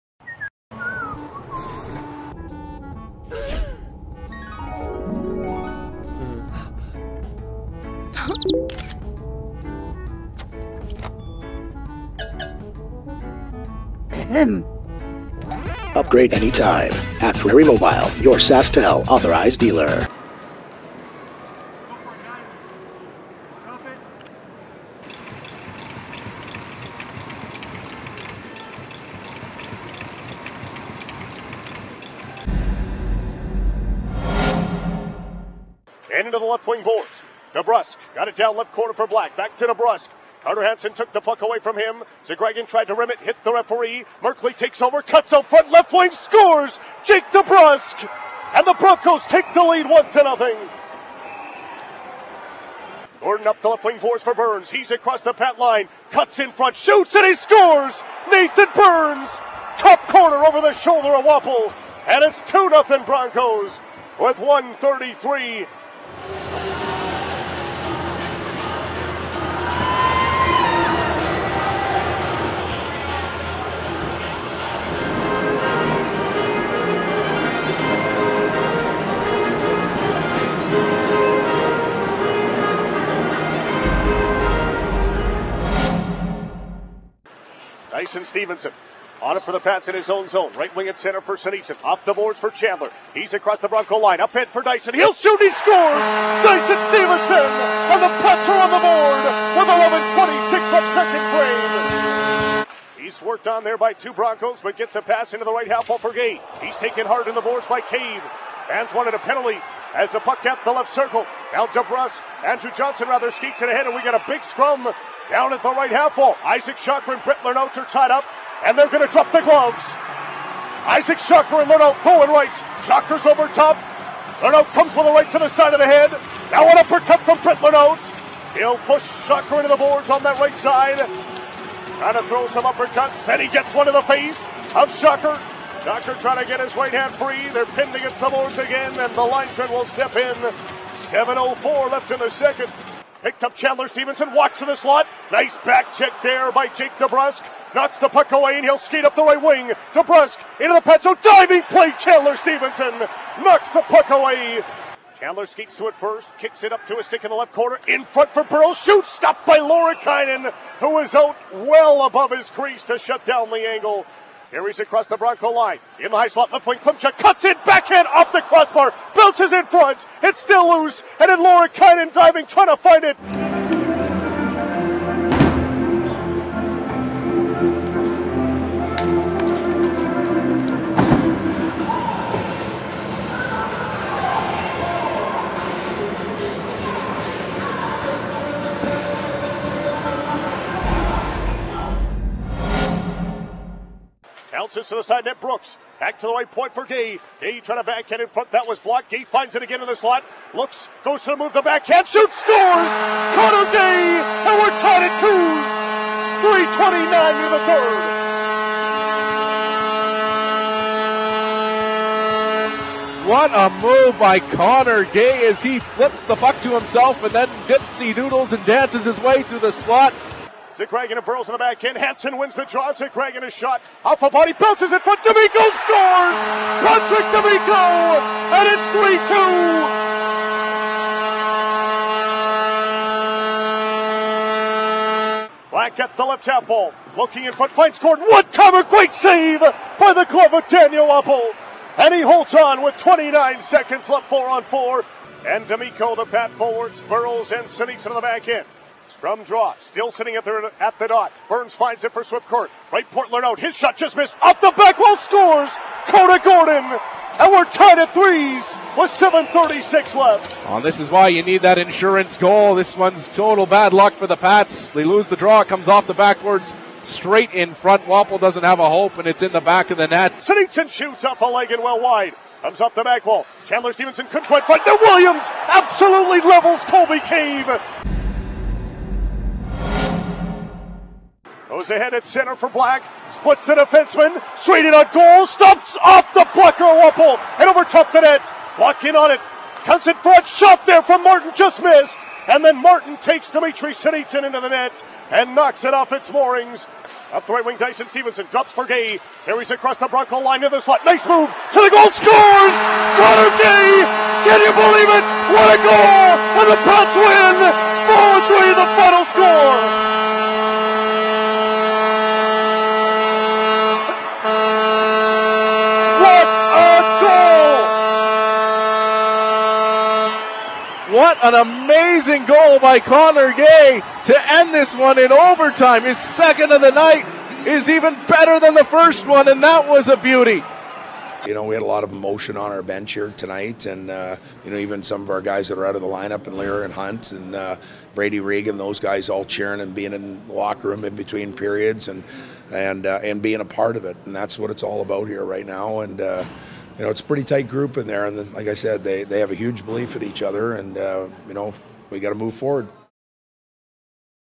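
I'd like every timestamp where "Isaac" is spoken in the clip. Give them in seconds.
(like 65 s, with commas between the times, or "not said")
116 s, 120 s.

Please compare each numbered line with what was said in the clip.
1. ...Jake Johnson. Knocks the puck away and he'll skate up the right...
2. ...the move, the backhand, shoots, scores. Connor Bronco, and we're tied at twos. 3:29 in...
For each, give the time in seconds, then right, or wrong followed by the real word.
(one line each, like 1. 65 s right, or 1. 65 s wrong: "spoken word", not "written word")
1. 146 s wrong: "DeBrusk", not "Johnson"
2. 201 s wrong: "Gay", not "Bronco".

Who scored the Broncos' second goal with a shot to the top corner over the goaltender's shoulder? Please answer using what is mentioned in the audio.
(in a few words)
Nathan Burns.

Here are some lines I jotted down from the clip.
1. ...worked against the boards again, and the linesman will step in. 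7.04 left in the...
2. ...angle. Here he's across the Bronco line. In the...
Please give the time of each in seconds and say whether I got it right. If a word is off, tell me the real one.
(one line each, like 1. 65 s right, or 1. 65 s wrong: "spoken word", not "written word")
1. 137 s wrong: "pinned", not "worked"
2. 163 s right.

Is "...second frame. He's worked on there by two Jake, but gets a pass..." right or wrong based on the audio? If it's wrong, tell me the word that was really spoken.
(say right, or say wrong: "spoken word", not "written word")
wrong: "Broncos", not "Jake".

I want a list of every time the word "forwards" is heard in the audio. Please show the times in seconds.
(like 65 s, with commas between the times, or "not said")
246 s, 352 s.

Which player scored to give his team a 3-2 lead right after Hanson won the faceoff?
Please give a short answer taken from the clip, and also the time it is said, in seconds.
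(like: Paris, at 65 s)
Patrick D'Amico, at 226 s.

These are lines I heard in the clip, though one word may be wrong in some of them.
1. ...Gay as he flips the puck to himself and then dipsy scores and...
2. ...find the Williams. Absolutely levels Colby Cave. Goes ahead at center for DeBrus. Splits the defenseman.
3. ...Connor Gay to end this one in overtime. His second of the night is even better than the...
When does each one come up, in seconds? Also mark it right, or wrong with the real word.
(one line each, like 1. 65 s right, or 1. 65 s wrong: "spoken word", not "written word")
1. 215 s wrong: "doodles", not "scores"
2. 274 s wrong: "Black", not "DeBrus"
3. 322 s right.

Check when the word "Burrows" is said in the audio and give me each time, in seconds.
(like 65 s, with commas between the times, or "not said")
221 s, 247 s.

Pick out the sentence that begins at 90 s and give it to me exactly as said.
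Right wing at center for Sinitsyn.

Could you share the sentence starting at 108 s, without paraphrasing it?
Fans wanted a penalty as the puck kept the left circle.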